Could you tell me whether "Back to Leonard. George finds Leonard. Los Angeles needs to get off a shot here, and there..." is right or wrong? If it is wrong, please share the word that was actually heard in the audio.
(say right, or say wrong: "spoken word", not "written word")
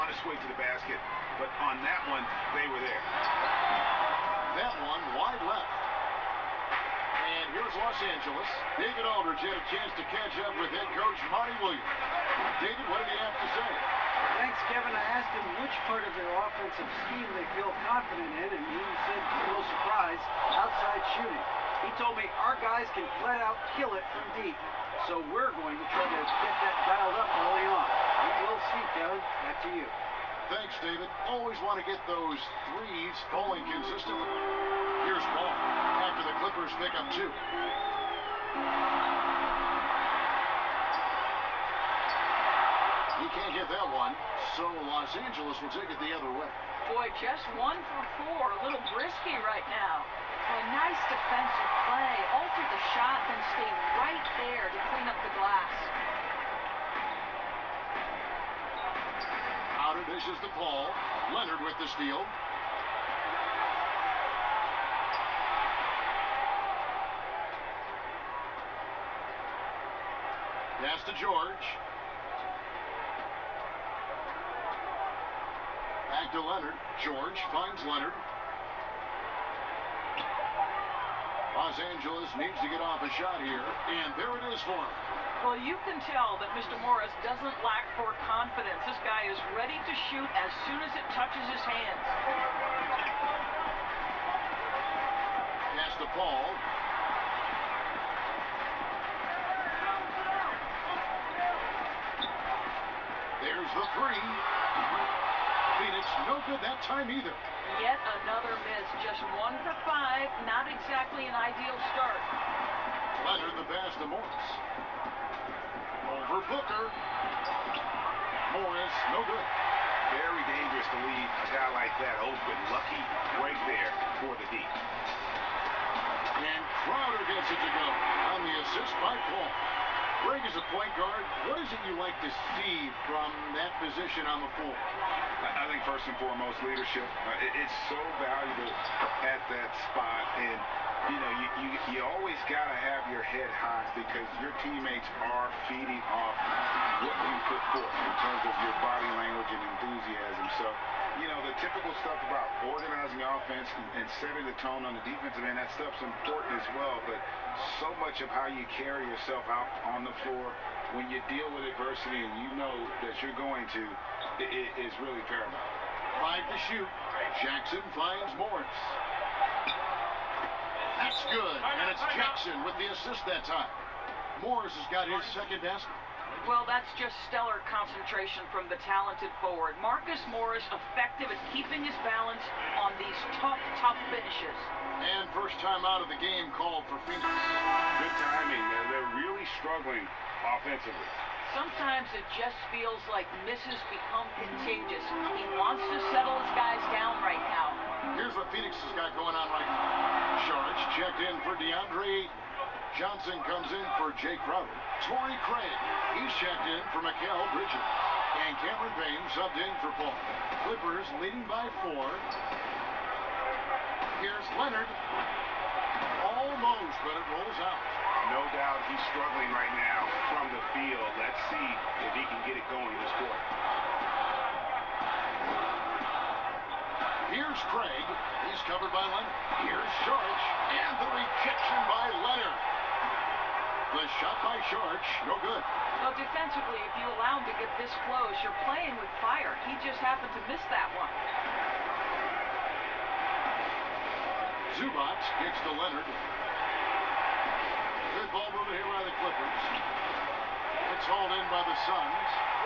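right.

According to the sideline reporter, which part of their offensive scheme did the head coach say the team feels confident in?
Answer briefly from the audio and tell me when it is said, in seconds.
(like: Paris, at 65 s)
Outside shooting, at 20 s.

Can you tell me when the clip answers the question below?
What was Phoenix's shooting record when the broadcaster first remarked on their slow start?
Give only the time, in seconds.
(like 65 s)
47 s.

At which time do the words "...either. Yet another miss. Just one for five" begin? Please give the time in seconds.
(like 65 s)
107 s.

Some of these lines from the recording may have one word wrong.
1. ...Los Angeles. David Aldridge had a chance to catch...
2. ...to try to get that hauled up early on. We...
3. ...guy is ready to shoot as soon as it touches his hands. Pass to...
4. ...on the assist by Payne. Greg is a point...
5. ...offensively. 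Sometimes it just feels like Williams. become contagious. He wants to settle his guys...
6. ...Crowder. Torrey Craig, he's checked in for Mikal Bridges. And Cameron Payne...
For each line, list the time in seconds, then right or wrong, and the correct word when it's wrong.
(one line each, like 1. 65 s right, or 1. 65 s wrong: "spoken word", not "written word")
1. 7 s right
2. 25 s wrong: "dialed", not "hauled"
3. 89 s right
4. 128 s wrong: "Paul", not "Payne"
5. 190 s wrong: "Mrs", not "Williams"
6. 204 s right.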